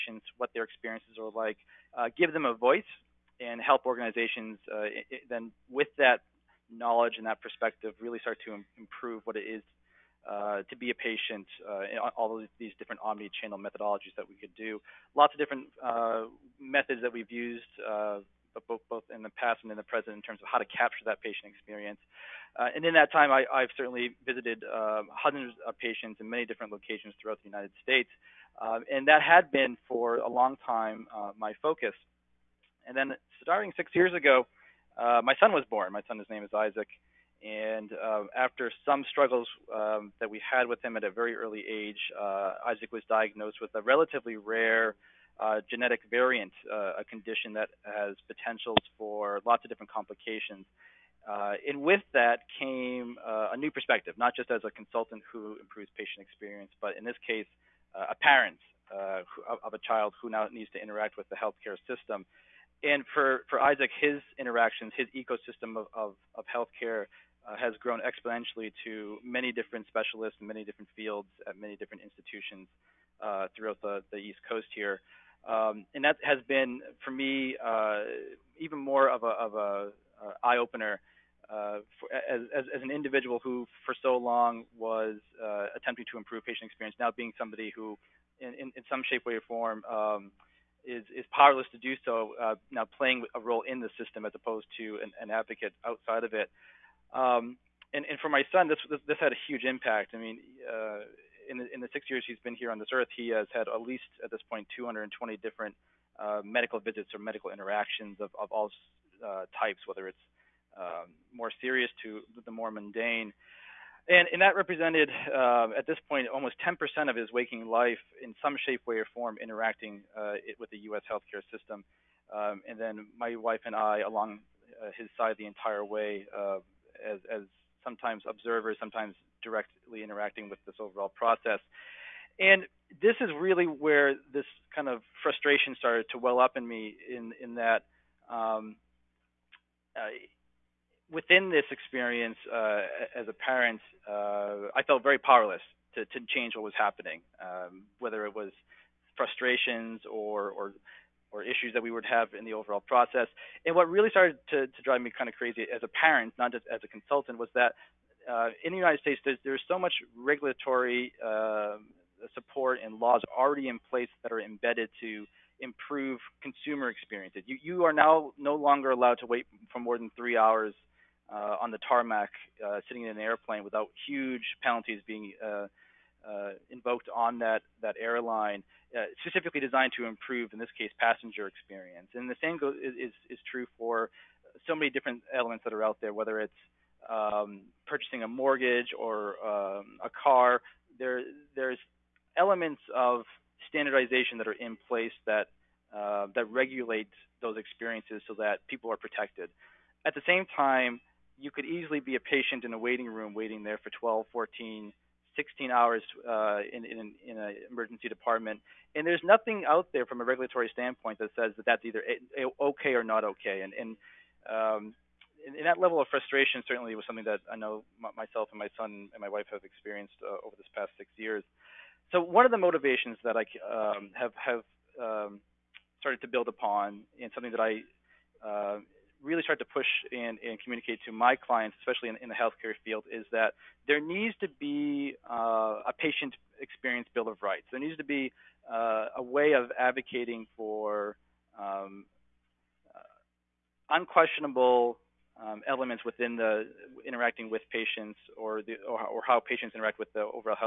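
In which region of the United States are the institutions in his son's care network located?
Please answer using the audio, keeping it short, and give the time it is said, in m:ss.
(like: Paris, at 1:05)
East Coast, at 1:14.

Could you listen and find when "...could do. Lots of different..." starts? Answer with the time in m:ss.
0:14.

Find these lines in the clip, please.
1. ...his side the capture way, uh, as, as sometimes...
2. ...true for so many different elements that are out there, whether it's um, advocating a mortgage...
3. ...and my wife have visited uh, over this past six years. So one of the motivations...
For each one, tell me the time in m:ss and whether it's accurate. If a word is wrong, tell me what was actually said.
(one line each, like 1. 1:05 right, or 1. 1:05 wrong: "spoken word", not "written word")
1. 2:04 wrong: "entire", not "capture"
2. 3:03 wrong: "purchasing", not "advocating"
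3. 3:39 wrong: "experienced", not "visited".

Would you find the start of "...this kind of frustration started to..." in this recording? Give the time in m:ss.
2:14.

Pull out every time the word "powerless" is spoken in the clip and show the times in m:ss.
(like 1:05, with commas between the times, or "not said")
1:31, 2:25.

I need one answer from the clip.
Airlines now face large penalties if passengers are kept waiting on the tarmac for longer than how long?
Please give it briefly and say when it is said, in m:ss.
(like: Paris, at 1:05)
3 hours, at 2:50.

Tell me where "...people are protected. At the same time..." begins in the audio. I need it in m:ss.
3:18.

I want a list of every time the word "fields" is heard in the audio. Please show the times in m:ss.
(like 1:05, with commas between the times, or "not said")
1:10, 3:52.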